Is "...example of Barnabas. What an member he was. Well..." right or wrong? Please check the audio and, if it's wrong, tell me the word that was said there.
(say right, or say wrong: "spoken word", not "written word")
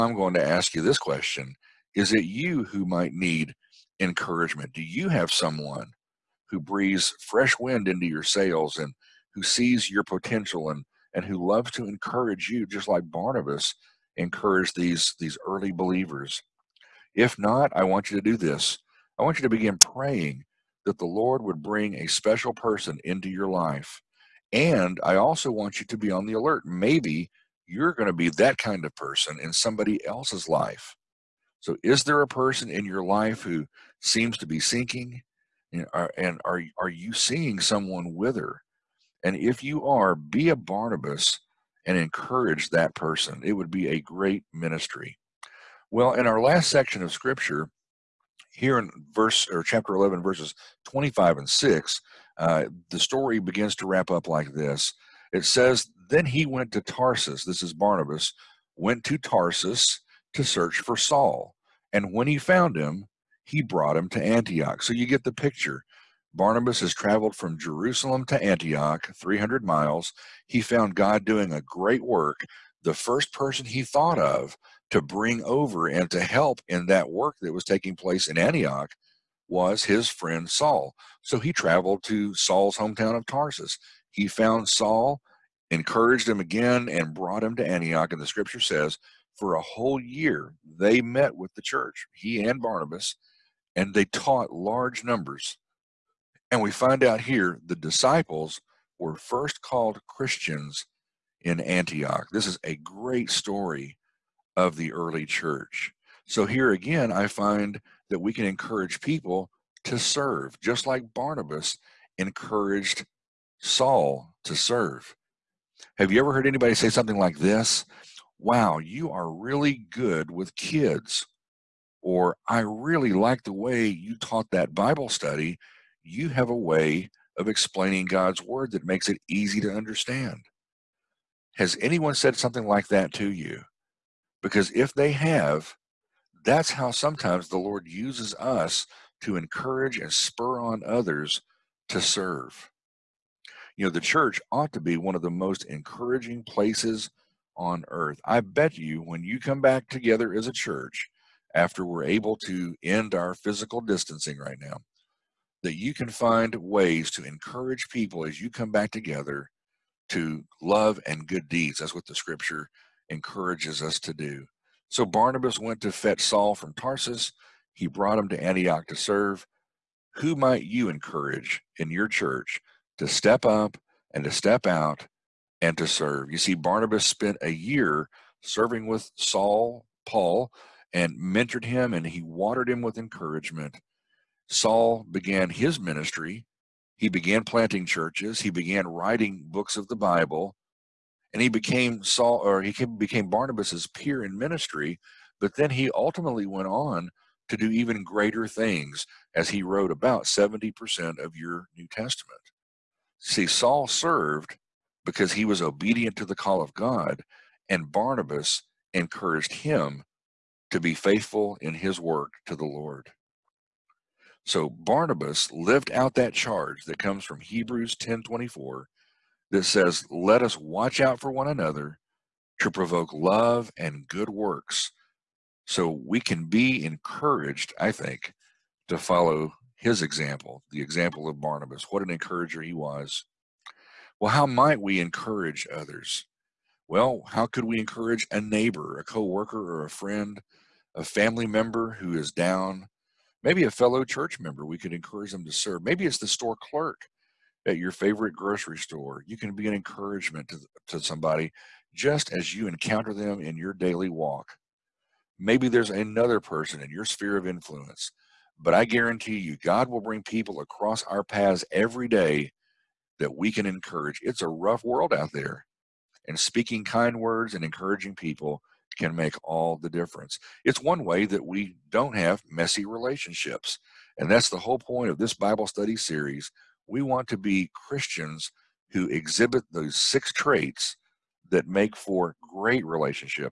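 wrong: "encourager", not "member".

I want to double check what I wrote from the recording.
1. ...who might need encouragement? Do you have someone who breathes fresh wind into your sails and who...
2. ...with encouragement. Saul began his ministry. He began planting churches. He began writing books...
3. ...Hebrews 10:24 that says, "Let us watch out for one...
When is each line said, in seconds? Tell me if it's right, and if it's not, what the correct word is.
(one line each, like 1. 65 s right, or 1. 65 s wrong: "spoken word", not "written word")
1. 2 s right
2. 182 s right
3. 217 s right.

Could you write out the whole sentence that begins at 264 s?
It's a rough world out there, and speaking kind words and encouraging people can make all the difference.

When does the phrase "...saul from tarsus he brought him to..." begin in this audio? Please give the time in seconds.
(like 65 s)
166 s.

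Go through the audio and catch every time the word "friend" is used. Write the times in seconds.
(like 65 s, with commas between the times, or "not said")
80 s, 239 s.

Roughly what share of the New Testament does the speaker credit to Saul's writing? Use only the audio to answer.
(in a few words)
70%.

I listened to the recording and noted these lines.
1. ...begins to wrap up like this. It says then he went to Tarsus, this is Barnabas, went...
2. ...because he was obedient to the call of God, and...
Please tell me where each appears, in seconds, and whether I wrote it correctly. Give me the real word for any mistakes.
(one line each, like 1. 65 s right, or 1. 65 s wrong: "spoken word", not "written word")
1. 53 s right
2. 205 s right.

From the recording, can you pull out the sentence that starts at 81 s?
So he traveled to Saul's hometown of Tarsus.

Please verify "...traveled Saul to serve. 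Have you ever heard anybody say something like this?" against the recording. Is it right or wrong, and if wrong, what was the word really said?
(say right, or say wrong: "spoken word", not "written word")
wrong: "encouraged", not "traveled".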